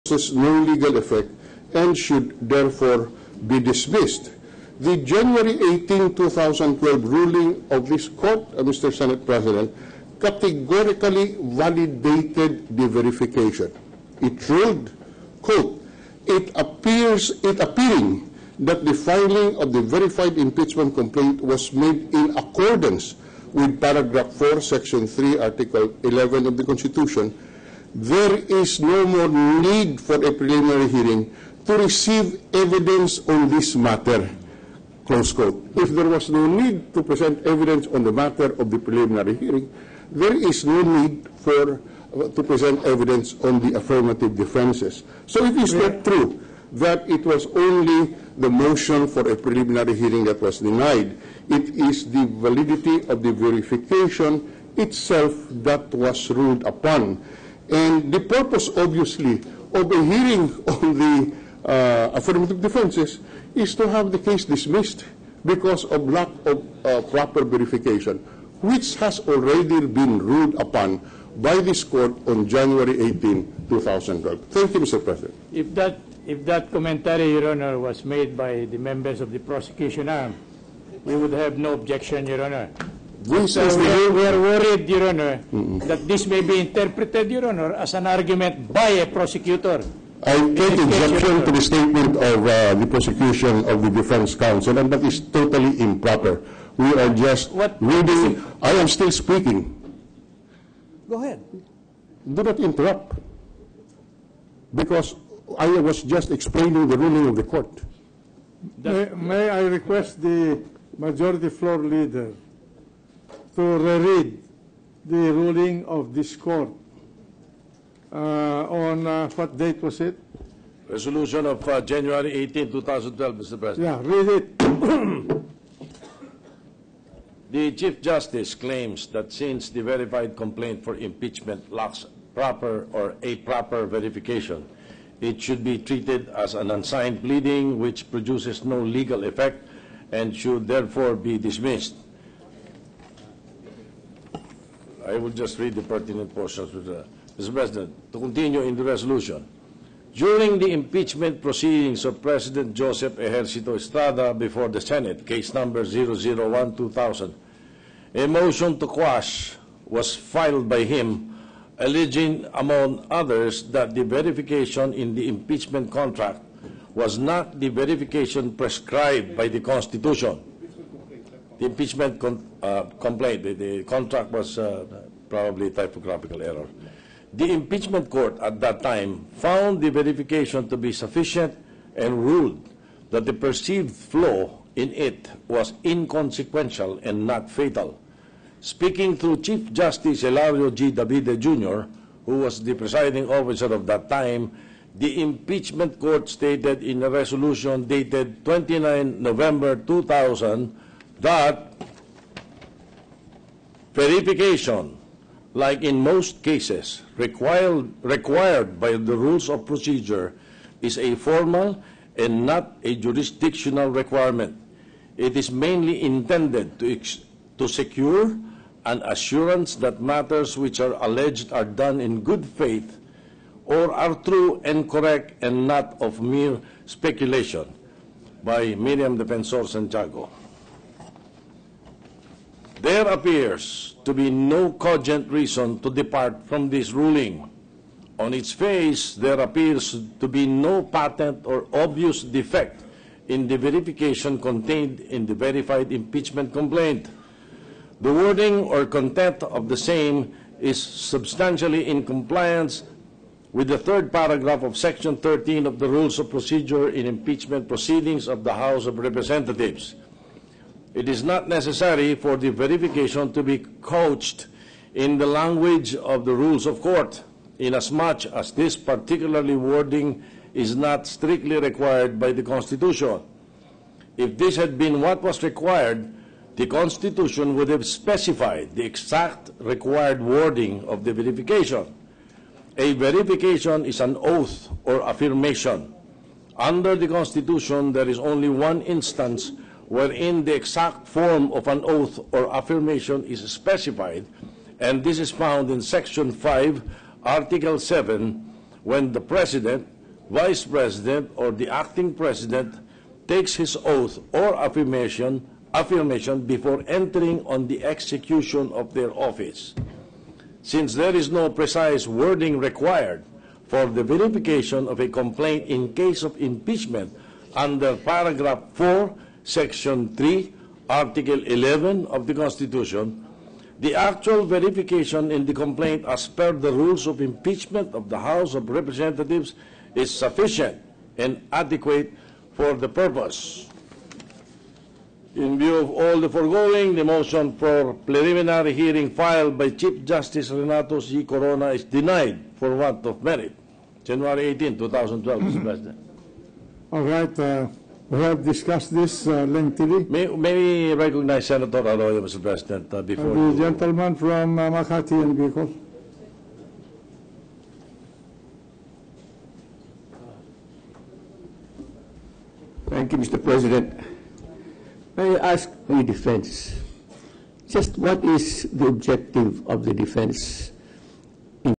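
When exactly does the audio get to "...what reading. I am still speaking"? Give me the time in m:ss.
1:37.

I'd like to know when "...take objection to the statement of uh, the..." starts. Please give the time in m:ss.
1:30.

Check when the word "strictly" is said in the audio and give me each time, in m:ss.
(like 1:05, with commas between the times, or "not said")
4:31.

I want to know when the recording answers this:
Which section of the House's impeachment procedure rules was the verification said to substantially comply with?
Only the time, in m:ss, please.
4:14.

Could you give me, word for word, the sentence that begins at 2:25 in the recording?
I will just read the pertinent portions.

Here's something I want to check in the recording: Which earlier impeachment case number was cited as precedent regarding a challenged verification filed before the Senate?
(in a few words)
001-2000.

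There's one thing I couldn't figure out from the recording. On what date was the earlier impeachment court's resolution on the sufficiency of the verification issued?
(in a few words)
29 November 2000.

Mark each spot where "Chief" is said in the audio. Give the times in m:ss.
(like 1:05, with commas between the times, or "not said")
2:07, 3:09, 5:39.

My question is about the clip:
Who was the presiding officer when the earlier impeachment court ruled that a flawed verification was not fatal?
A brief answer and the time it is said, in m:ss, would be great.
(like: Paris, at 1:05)
Hilario G. Davide Jr., at 3:10.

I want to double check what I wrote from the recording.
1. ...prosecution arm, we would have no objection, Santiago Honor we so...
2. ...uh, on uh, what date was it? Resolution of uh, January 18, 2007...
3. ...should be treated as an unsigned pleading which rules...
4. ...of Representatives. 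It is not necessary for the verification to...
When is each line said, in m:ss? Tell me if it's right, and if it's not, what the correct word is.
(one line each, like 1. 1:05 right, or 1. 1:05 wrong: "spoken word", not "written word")
1. 1:19 wrong: "Your", not "Santiago"
2. 1:58 wrong: "2012", not "2007"
3. 2:15 wrong: "produces", not "rules"
4. 4:18 right.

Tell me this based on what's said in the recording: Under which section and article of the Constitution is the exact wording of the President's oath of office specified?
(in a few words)
Section 5, Article 7.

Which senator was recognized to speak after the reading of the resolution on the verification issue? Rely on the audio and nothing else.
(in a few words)
Senator Arroyo.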